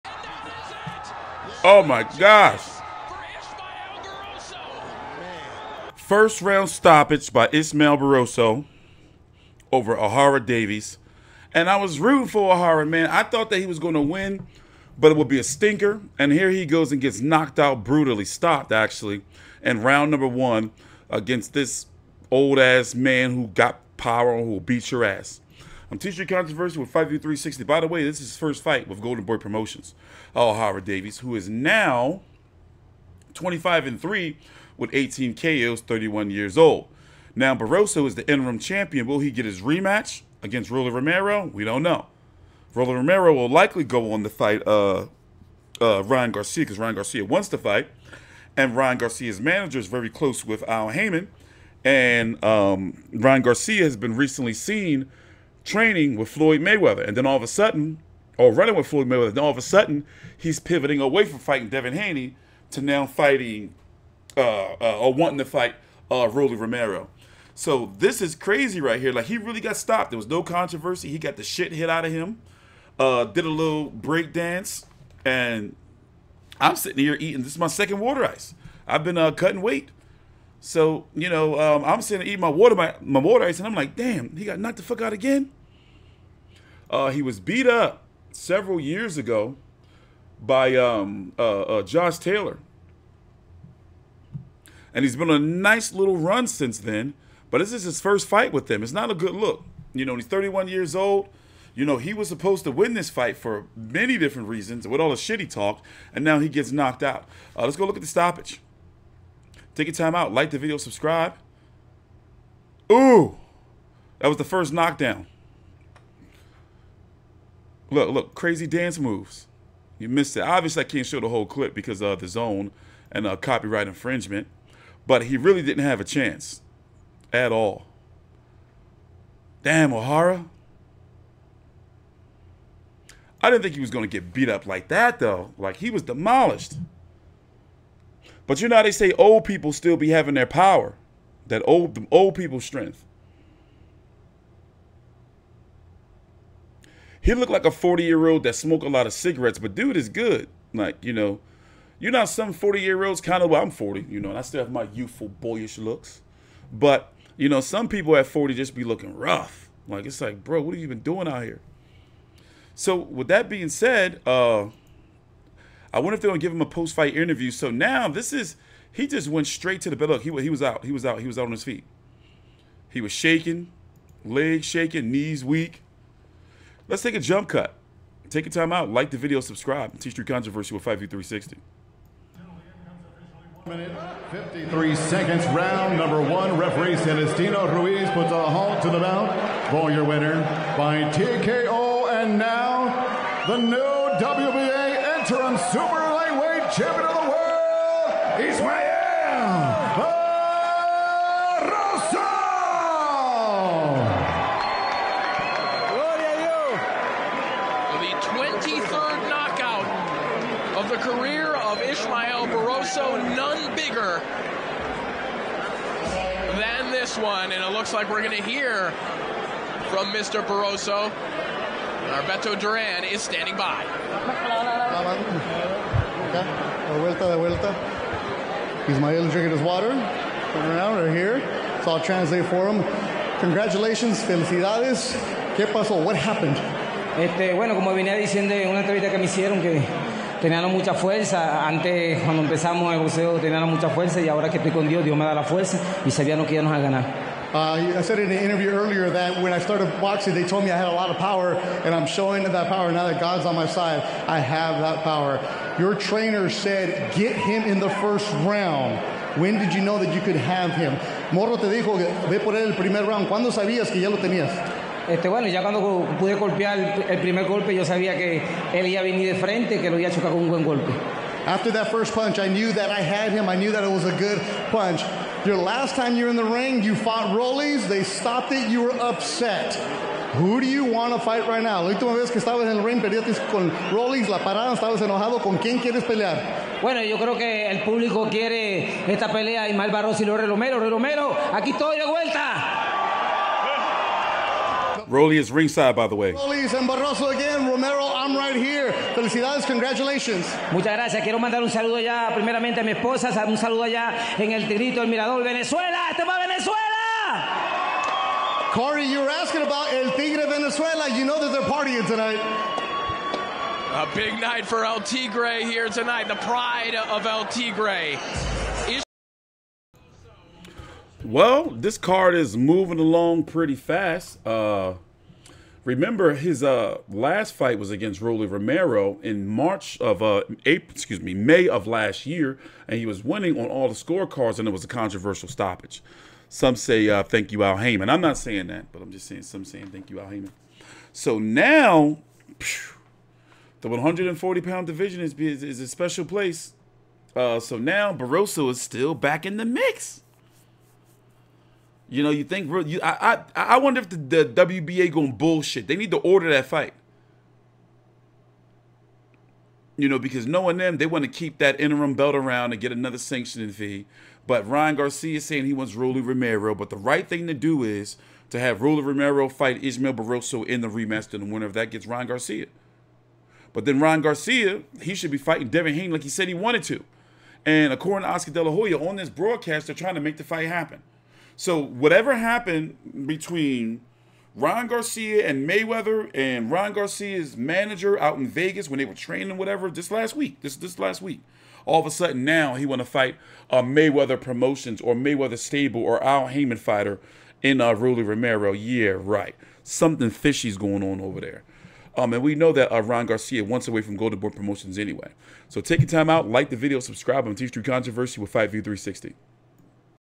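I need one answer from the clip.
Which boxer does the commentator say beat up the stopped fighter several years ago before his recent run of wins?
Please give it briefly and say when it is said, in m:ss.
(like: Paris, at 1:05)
Josh Taylor, at 1:31.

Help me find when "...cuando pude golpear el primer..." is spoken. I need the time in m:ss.
4:25.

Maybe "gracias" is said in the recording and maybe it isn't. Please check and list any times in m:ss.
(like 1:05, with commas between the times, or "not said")
5:00.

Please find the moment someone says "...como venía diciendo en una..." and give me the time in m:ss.
3:57.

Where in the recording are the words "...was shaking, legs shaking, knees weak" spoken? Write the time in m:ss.
2:53.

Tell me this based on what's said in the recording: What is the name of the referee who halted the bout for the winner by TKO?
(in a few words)
Celestino Ruiz.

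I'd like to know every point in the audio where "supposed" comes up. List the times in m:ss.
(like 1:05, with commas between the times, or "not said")
1:42.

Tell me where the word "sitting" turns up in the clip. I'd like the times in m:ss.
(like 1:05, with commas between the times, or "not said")
1:16, 1:22.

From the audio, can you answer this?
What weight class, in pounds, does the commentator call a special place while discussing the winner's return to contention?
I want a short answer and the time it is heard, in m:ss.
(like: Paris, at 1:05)
140, at 5:43.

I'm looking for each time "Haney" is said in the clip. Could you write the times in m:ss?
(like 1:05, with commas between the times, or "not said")
1:01, 6:15.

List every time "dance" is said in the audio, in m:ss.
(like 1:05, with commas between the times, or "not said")
1:14, 1:58.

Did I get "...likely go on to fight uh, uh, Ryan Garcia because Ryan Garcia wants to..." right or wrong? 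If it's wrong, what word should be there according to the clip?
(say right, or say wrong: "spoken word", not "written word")
right.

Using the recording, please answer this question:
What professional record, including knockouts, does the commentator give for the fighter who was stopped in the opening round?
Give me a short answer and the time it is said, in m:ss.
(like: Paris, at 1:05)
25 and 3 with 18 KOs, at 0:33.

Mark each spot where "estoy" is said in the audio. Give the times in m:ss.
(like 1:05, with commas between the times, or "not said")
4:04, 4:51.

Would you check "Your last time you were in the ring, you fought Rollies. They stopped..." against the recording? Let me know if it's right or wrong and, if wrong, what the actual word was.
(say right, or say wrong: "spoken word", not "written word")
right.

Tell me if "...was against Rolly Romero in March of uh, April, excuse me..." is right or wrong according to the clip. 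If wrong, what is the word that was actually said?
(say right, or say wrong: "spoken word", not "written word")
right.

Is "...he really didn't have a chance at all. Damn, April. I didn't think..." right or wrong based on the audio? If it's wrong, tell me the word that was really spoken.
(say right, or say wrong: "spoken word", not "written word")
wrong: "Ohara", not "April".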